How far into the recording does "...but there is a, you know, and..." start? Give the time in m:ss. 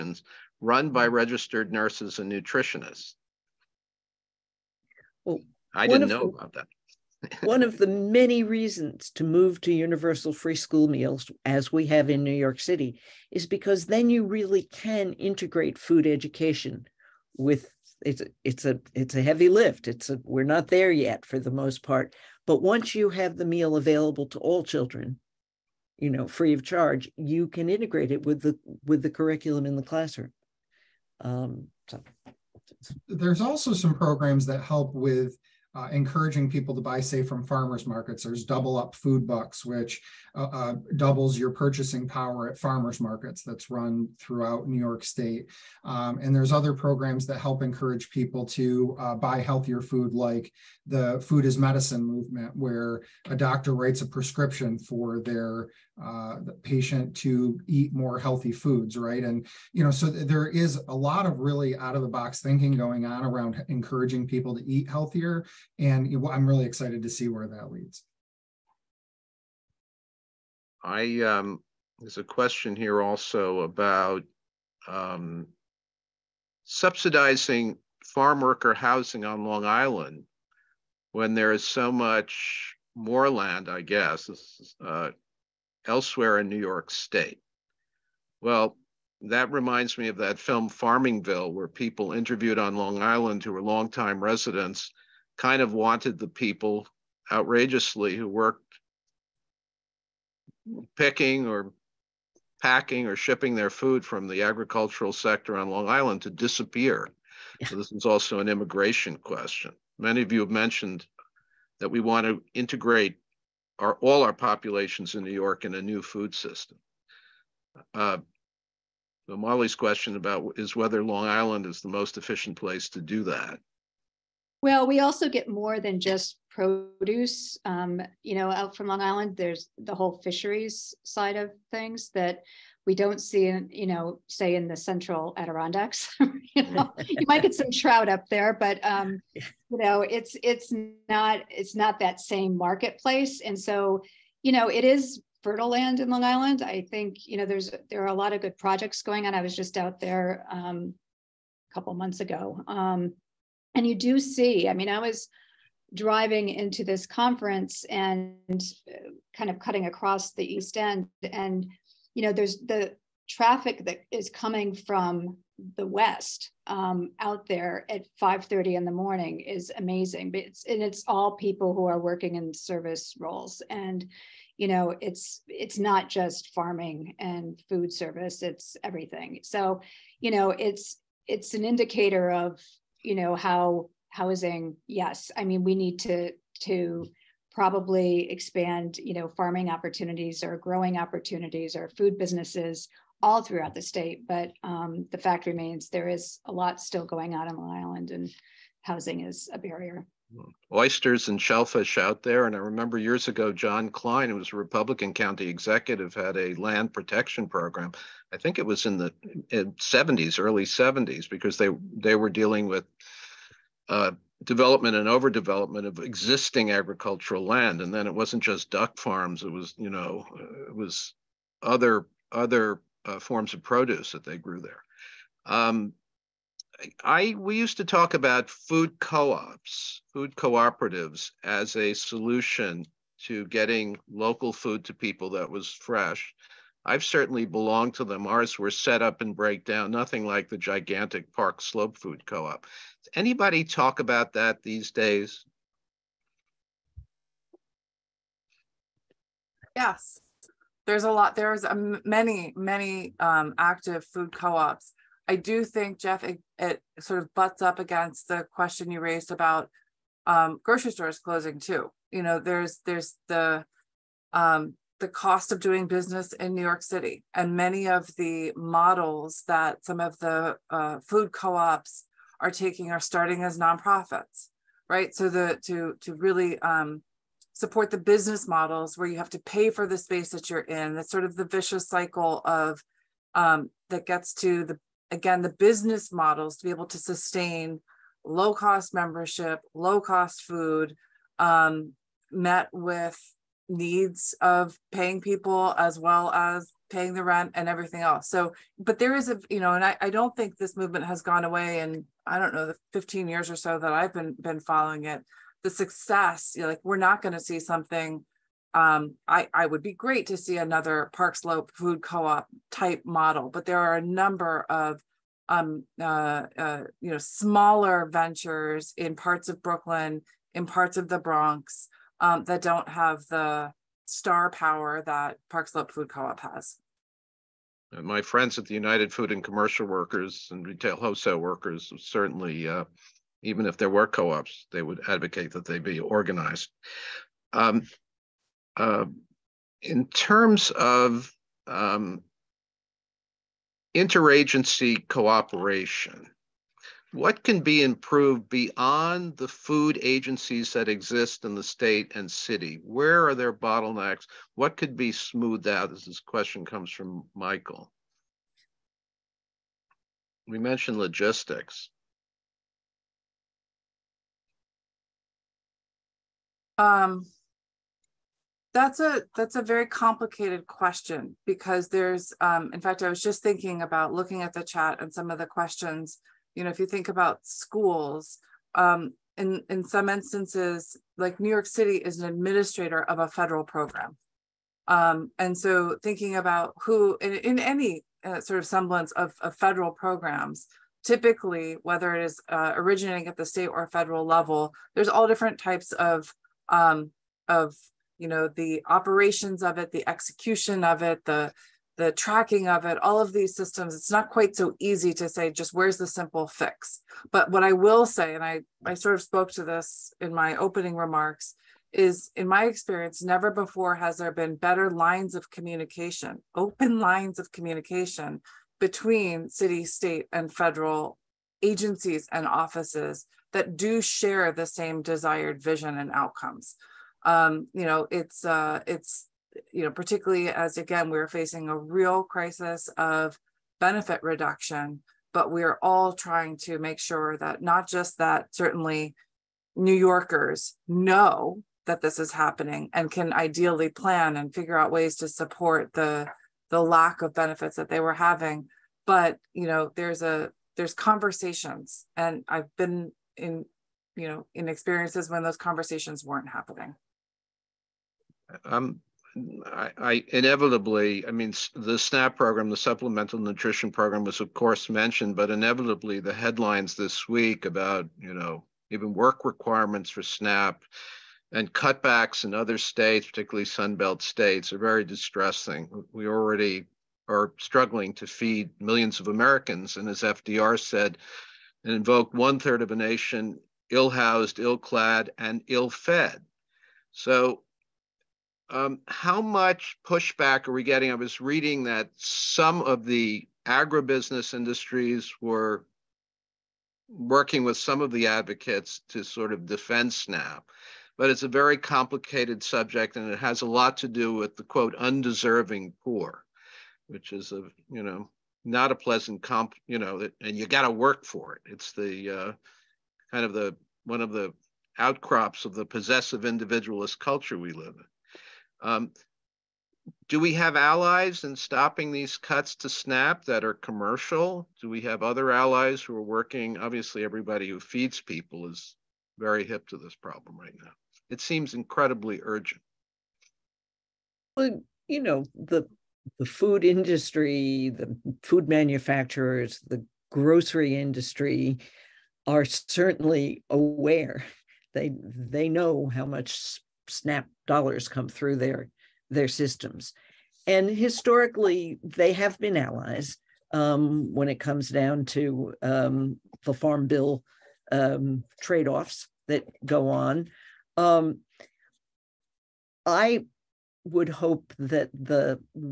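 4:58.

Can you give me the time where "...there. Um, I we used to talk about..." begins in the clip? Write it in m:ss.
3:44.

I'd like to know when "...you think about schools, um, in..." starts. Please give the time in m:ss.
6:16.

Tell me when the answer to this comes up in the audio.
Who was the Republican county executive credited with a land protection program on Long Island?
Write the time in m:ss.
3:23.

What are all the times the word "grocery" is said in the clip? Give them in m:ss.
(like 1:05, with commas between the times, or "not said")
4:20, 9:00.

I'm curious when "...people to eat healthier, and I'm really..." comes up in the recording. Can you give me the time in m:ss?
1:04.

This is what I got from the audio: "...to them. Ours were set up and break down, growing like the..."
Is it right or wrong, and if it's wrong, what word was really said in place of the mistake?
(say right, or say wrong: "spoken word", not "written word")
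wrong: "nothing", not "growing".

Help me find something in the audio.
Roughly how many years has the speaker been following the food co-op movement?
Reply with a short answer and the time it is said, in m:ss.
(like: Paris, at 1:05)
15, at 5:02.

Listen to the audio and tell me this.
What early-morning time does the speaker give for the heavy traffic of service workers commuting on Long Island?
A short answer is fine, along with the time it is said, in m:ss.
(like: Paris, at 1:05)
5:30, at 2:48.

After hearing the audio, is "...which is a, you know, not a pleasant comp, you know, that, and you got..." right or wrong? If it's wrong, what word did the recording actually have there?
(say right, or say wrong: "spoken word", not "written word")
right.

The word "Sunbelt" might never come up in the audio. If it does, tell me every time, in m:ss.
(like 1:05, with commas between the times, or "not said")
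7:53.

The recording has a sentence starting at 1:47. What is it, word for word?
So this is also an immigration question.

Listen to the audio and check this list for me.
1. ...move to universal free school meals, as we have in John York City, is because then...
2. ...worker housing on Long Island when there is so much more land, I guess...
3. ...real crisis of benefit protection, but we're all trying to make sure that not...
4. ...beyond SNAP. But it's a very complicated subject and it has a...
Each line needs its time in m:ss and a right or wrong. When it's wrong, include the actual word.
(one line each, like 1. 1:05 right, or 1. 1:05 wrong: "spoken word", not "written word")
1. 0:09 wrong: "New", not "John"
2. 1:18 right
3. 7:11 wrong: "reduction", not "protection"
4. 8:19 wrong: "defend", not "beyond".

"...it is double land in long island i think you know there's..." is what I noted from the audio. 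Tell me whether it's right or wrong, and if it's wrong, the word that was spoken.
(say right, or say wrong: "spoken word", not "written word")
wrong: "fertile", not "double".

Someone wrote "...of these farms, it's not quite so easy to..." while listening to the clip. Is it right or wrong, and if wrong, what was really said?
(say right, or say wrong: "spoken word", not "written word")
wrong: "systems", not "farms".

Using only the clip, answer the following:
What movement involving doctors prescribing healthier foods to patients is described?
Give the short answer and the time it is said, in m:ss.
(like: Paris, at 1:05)
Food is Medicine, at 0:51.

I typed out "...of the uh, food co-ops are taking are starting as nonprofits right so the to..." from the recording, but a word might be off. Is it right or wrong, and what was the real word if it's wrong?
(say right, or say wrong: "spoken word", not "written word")
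right.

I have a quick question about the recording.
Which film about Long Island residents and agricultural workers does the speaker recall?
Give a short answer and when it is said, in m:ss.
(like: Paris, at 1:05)
Farmingville, at 1:30.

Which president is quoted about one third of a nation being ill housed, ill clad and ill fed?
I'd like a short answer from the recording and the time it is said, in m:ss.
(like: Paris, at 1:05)
FDR, at 8:00.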